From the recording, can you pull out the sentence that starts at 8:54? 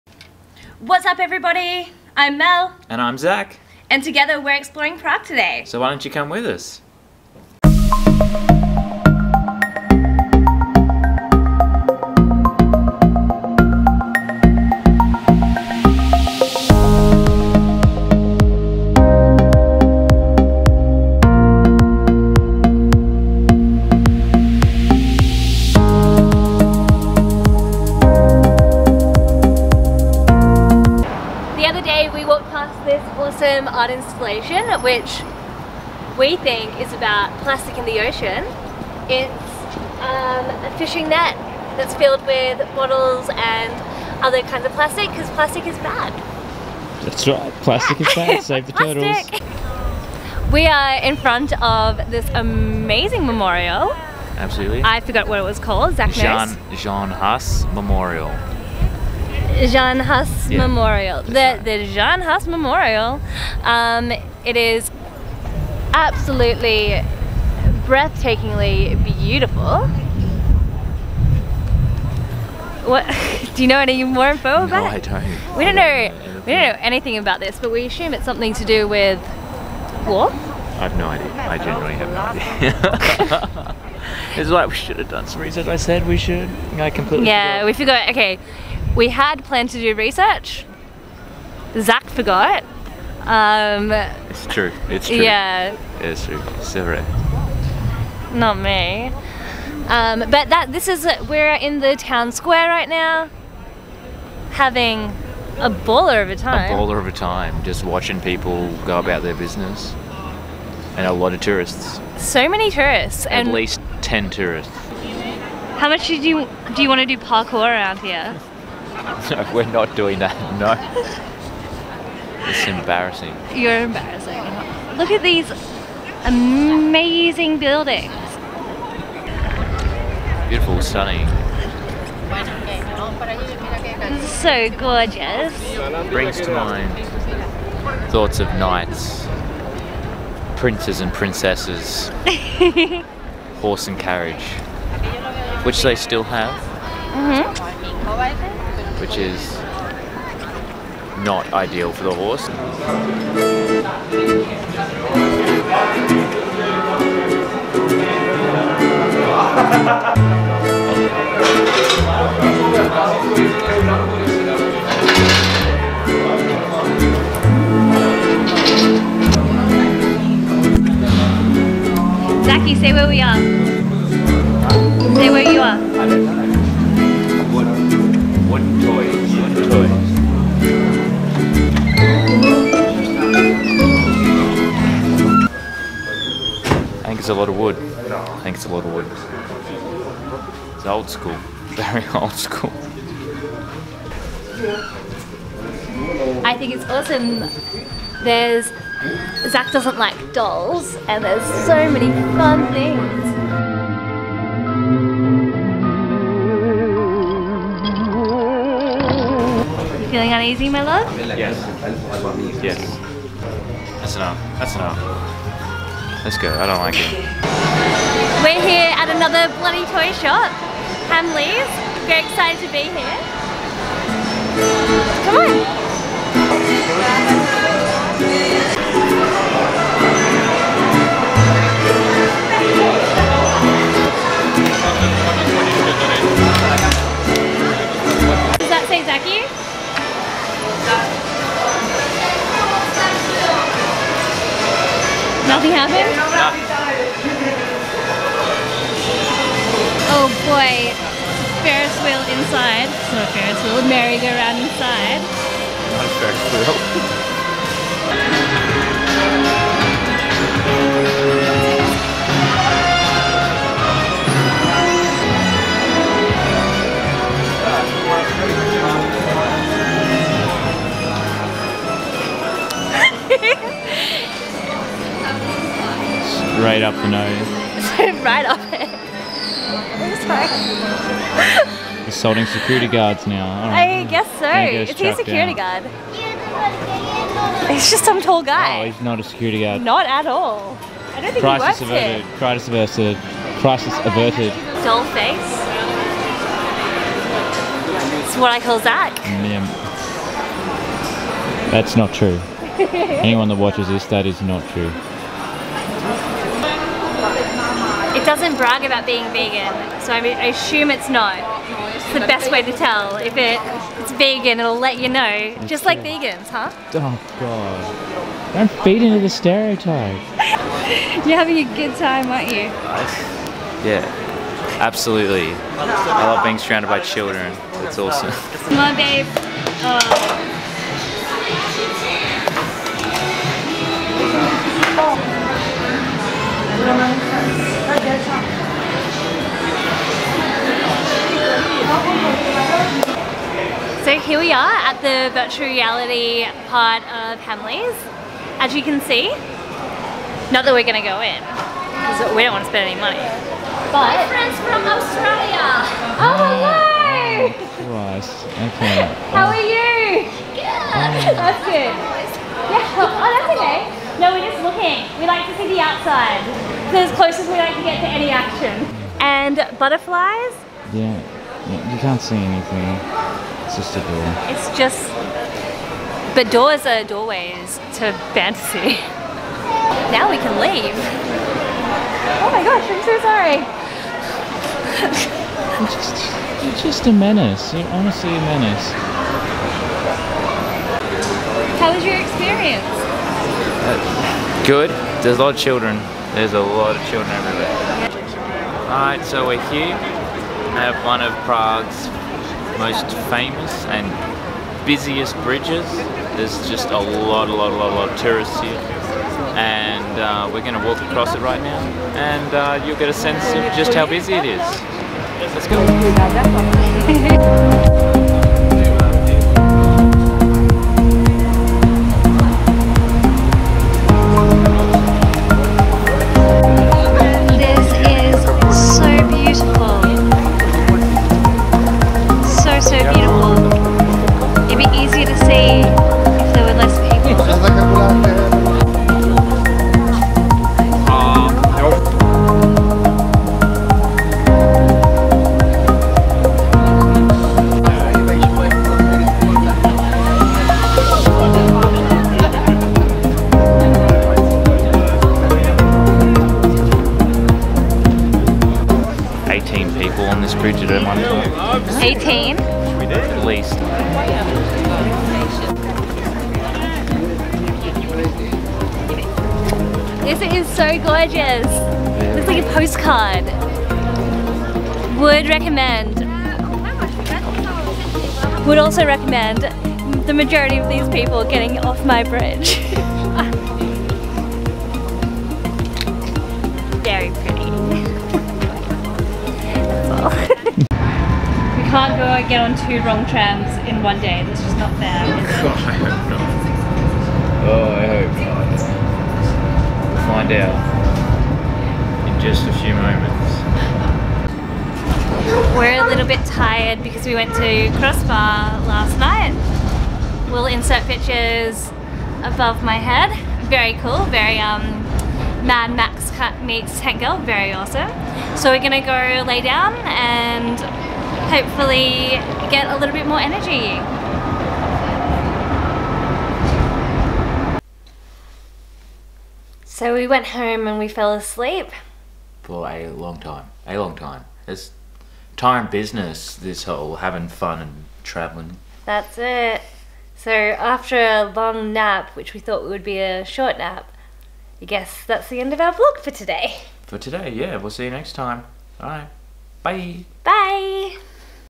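It's time business, this whole having fun and travelling.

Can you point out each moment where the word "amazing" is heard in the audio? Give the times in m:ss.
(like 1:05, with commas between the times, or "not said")
0:52, 2:06.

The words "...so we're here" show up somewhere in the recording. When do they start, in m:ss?
6:39.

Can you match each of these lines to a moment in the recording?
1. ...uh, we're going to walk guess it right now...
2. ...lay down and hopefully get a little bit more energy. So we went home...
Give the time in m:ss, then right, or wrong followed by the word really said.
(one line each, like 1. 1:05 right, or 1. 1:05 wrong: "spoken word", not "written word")
1. 6:50 wrong: "across", not "guess"
2. 8:39 right.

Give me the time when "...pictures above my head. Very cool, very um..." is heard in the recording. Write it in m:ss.
8:31.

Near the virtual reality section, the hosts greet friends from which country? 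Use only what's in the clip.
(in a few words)
Australia.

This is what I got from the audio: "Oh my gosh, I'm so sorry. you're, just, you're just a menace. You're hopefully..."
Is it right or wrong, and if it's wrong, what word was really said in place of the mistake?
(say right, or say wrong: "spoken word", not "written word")
wrong: "honestly", not "hopefully".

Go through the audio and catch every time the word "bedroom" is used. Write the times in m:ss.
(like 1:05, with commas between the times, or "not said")
not said.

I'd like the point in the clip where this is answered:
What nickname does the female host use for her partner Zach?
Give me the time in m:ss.
4:54.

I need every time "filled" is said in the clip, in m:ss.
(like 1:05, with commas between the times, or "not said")
0:41.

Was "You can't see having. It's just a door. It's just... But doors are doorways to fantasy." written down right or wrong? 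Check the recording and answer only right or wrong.
wrong.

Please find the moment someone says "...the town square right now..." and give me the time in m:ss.
1:41.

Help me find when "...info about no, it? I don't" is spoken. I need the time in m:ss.
1:14.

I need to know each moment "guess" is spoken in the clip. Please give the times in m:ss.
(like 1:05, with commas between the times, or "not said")
4:44, 9:04.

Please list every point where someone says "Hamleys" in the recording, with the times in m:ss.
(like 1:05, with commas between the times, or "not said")
3:41, 5:47.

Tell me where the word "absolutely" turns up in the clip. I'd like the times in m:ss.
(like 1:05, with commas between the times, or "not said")
0:54, 1:05, 5:24.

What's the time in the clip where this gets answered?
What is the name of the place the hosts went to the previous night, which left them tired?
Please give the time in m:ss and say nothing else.
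8:27.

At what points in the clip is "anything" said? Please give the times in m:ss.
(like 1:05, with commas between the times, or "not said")
1:16, 6:12.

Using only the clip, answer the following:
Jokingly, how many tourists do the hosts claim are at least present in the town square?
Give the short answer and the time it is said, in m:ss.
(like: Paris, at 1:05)
10, at 1:54.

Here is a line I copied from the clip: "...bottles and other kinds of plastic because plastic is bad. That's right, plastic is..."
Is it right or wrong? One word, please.
right.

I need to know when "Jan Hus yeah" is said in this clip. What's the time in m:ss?
0:59.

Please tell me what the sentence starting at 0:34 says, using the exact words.
which we think is about plastic in the ocean.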